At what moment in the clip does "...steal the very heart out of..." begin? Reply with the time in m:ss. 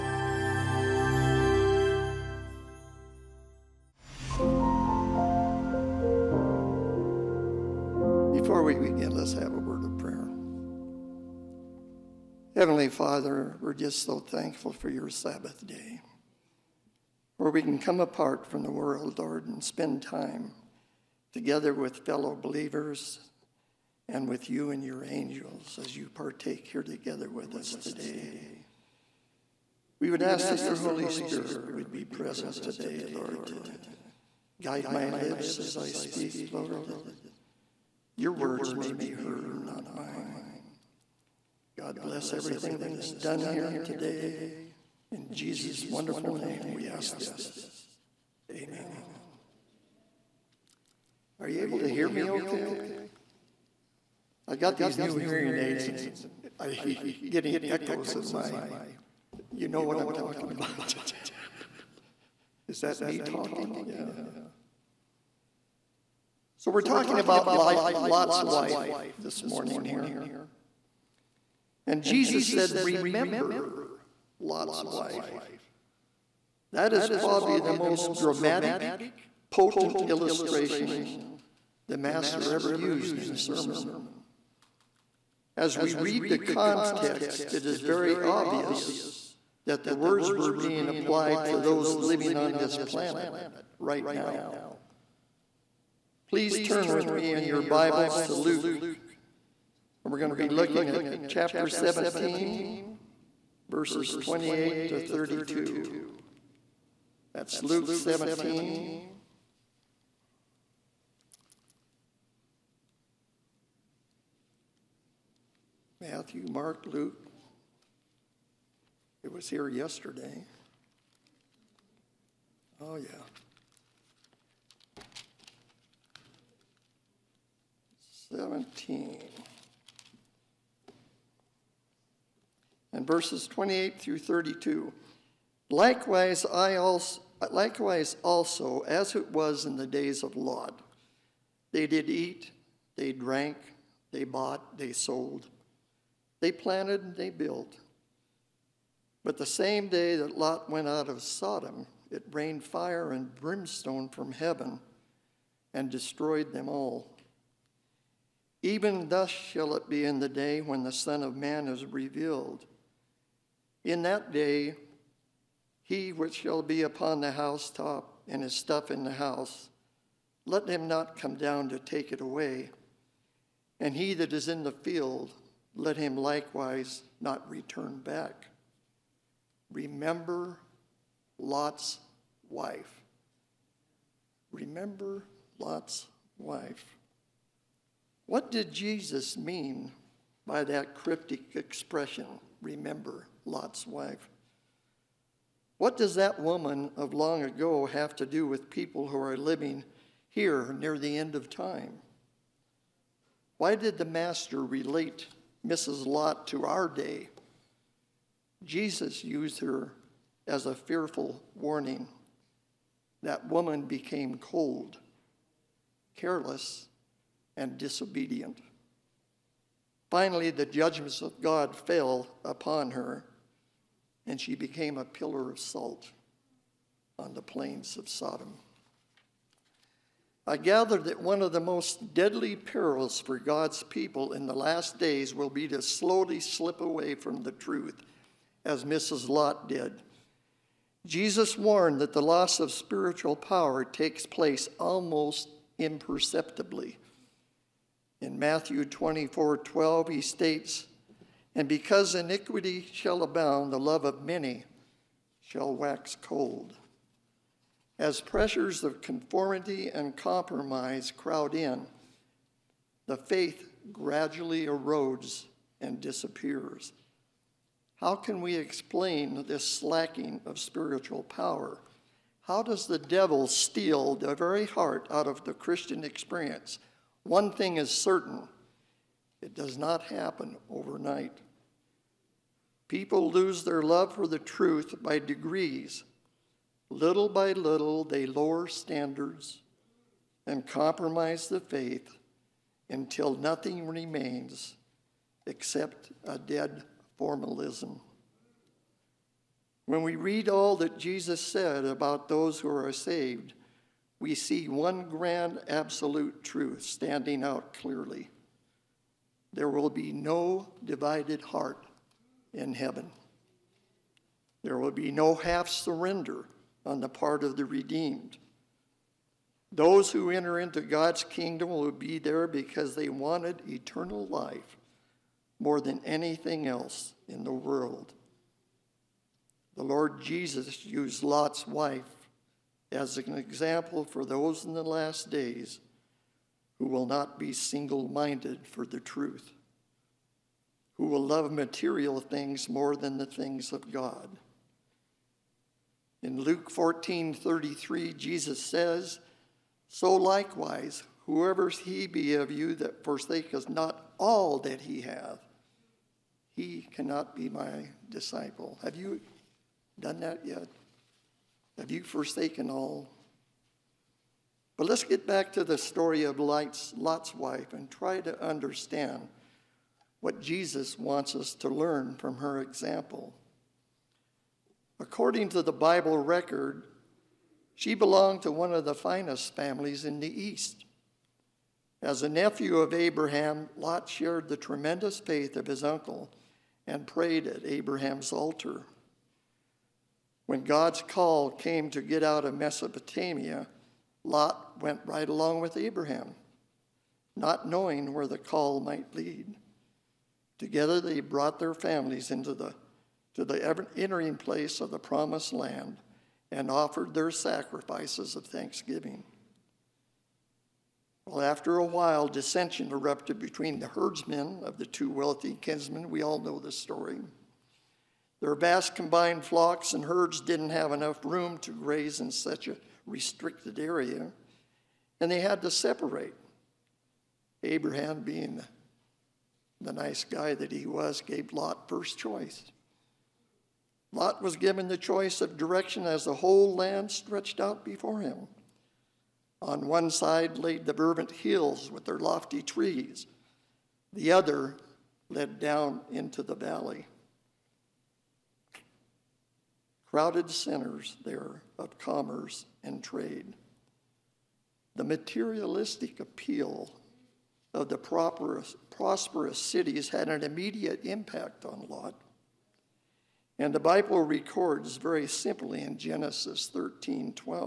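4:33.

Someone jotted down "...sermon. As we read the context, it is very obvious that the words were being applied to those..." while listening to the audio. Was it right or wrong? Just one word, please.
right.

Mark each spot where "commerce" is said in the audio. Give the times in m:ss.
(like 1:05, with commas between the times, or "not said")
7:31.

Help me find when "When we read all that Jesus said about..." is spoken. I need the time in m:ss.
4:59.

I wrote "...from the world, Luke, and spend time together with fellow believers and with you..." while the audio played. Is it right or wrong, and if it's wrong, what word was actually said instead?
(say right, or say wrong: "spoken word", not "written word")
wrong: "Lord", not "Luke".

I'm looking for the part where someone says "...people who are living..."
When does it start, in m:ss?
3:18.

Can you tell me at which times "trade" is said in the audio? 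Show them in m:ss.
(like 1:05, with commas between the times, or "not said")
7:33.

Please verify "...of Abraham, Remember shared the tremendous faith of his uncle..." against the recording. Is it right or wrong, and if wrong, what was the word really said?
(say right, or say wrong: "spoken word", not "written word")
wrong: "Lot", not "Remember".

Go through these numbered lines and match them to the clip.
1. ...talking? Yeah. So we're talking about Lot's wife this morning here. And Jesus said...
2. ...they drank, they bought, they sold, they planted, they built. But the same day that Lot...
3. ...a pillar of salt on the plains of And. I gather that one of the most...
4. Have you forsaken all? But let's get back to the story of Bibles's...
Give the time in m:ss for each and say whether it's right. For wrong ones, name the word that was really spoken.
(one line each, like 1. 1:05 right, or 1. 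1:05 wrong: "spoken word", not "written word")
1. 1:03 right
2. 2:22 right
3. 3:44 wrong: "Sodom", not "And"
4. 6:01 wrong: "Lot", not "Bibles".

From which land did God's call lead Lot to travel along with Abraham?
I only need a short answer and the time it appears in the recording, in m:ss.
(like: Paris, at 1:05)
Mesopotamia, at 6:32.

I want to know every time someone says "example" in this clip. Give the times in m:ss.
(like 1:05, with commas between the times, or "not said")
5:33, 6:12.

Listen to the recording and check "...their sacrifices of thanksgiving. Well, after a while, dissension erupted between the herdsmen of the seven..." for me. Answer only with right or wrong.
wrong.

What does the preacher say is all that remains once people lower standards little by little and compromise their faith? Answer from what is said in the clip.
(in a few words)
A dead formalism.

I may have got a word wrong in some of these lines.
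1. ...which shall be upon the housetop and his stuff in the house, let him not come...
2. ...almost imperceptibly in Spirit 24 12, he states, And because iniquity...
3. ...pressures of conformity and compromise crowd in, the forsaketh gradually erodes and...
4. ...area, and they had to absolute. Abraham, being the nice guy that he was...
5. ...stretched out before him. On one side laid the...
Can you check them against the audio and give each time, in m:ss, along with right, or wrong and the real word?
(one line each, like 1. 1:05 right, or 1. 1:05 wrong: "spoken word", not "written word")
1. 2:46 right
2. 4:04 wrong: "Matthew", not "Spirit"
3. 4:18 wrong: "faith", not "forsaketh"
4. 7:03 wrong: "separate", not "absolute"
5. 7:17 right.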